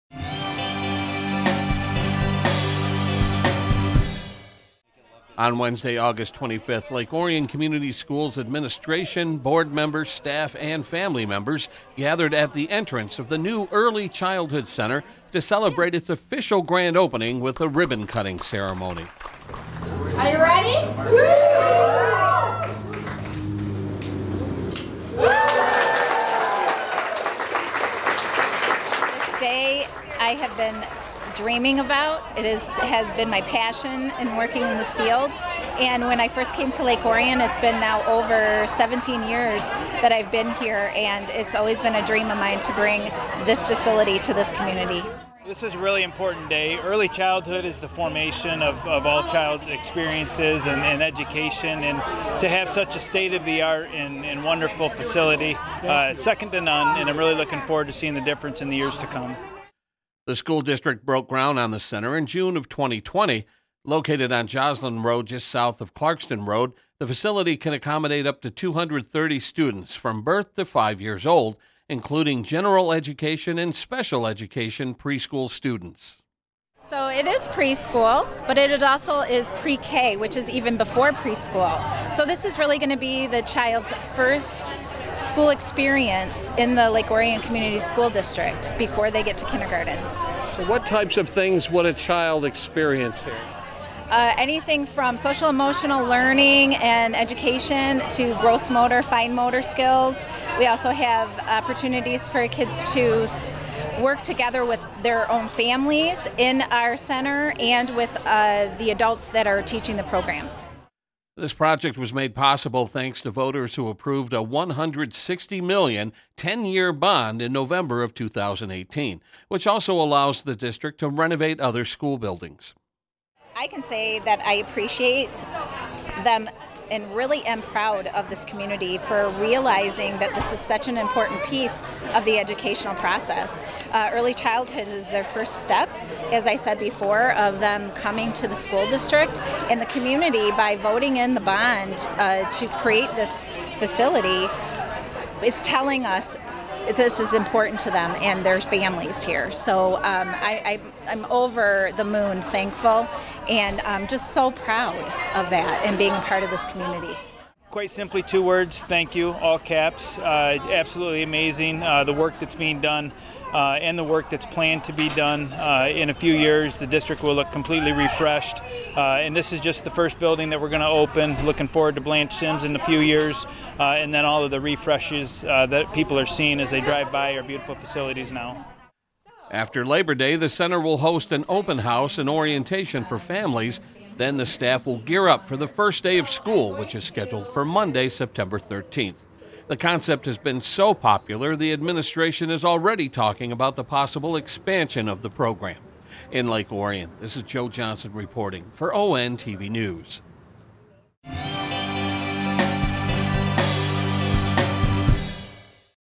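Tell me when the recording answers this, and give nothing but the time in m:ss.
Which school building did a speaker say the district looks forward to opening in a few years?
2:52.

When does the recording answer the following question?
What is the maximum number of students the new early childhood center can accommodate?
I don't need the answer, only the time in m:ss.
1:08.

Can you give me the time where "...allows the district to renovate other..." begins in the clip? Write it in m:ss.
1:59.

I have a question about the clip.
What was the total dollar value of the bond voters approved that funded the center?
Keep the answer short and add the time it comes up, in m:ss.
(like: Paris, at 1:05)
$160 million, at 1:54.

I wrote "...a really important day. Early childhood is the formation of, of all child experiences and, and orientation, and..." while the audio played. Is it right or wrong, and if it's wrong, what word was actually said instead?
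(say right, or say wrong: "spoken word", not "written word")
wrong: "education", not "orientation".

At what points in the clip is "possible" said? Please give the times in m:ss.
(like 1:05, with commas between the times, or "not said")
1:52, 3:13.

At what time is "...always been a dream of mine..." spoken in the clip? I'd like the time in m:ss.
0:41.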